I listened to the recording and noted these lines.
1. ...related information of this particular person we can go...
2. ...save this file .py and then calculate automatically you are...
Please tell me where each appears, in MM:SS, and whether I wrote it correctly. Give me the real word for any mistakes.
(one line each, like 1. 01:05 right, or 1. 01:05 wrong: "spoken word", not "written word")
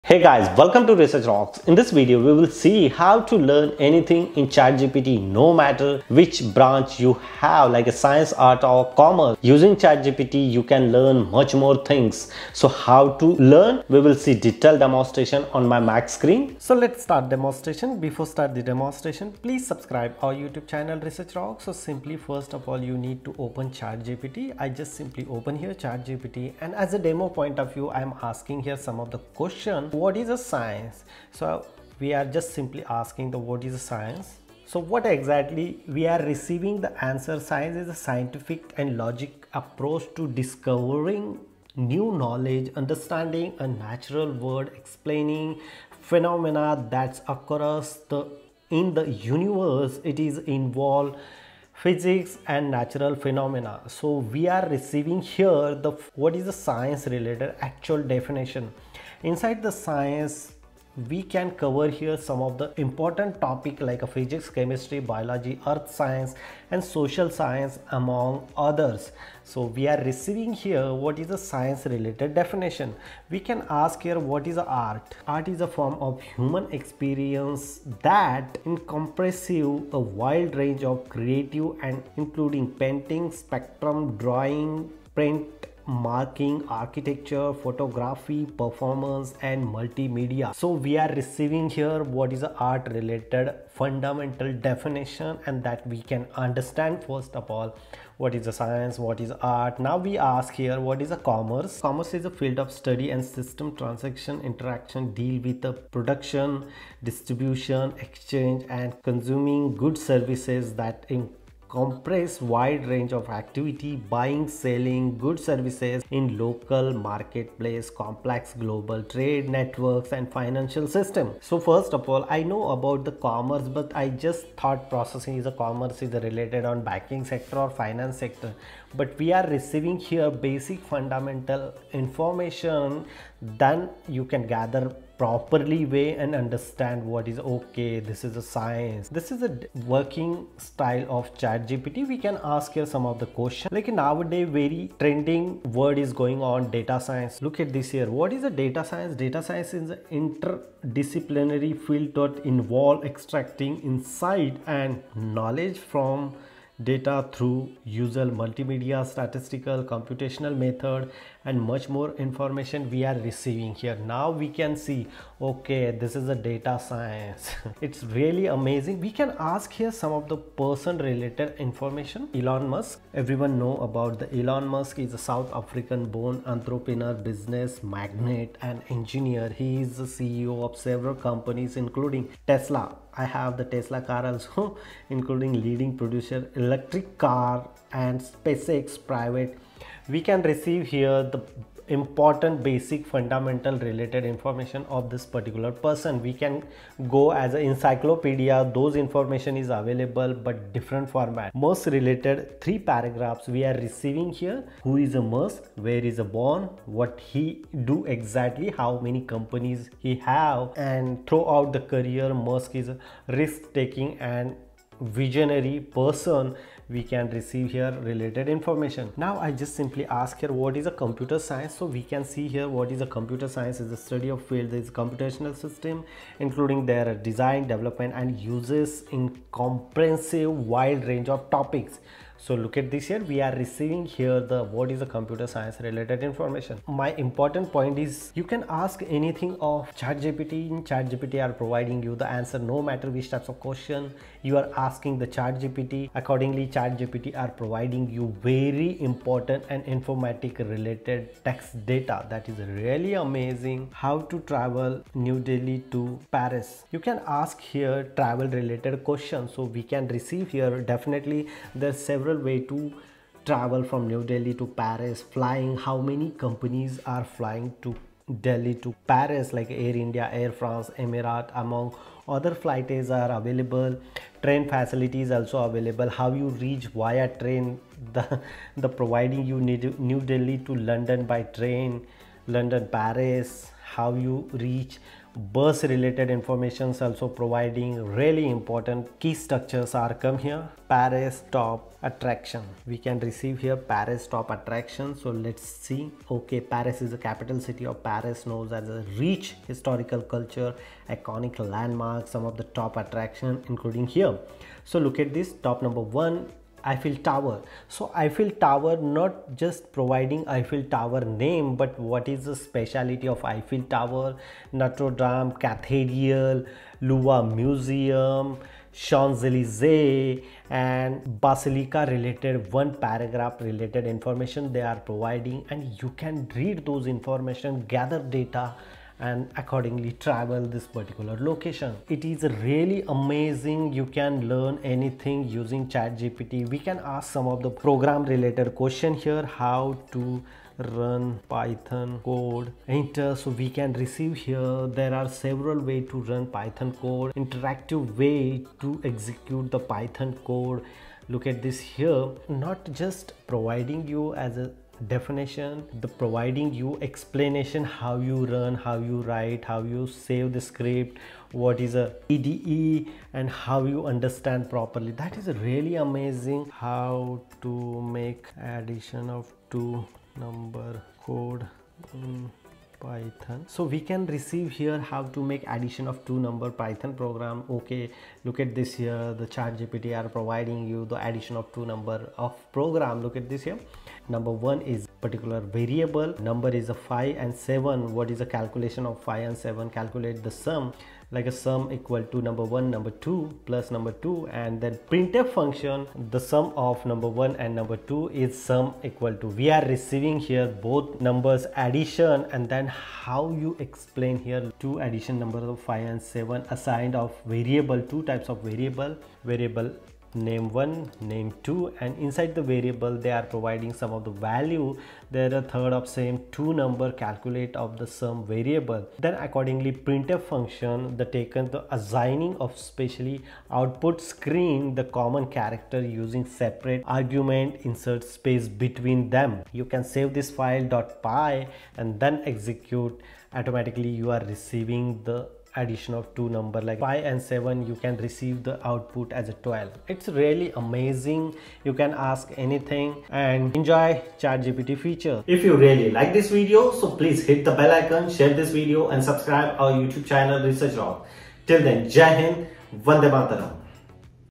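1. 03:13 right
2. 07:10 wrong: "execute", not "calculate".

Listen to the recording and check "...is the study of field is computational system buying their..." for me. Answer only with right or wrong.
wrong.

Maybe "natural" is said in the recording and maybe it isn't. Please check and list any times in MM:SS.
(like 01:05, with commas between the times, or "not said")
00:43, 00:52.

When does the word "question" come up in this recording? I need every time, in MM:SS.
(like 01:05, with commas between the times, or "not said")
00:29, 02:23, 04:03, 04:19, 05:38.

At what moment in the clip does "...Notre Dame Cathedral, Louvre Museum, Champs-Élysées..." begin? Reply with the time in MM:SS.
05:14.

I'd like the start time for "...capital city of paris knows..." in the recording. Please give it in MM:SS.
04:57.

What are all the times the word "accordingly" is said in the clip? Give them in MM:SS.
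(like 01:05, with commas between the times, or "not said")
04:06, 05:29, 06:59.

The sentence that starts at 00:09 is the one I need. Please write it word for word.
Using ChatGPT, you can learn much more things.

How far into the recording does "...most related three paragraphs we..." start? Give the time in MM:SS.
03:21.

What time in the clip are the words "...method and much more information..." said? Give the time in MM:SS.
02:40.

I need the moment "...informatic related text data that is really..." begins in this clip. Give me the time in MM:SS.
04:09.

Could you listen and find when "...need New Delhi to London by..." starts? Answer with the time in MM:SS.
04:39.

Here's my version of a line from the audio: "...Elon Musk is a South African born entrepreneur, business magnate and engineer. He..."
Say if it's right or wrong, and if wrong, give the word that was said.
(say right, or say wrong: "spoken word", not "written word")
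right.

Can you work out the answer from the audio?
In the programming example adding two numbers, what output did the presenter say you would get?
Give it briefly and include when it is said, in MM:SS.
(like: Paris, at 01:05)
12, at 07:19.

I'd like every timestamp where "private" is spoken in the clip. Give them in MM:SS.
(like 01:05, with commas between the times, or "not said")
03:09.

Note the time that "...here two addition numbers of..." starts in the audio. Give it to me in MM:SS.
06:44.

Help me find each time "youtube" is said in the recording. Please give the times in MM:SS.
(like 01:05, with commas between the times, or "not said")
00:20, 07:29.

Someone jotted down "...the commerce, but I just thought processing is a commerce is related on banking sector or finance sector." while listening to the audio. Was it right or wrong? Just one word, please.
right.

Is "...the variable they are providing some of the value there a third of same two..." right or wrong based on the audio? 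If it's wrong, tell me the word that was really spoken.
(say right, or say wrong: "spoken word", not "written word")
right.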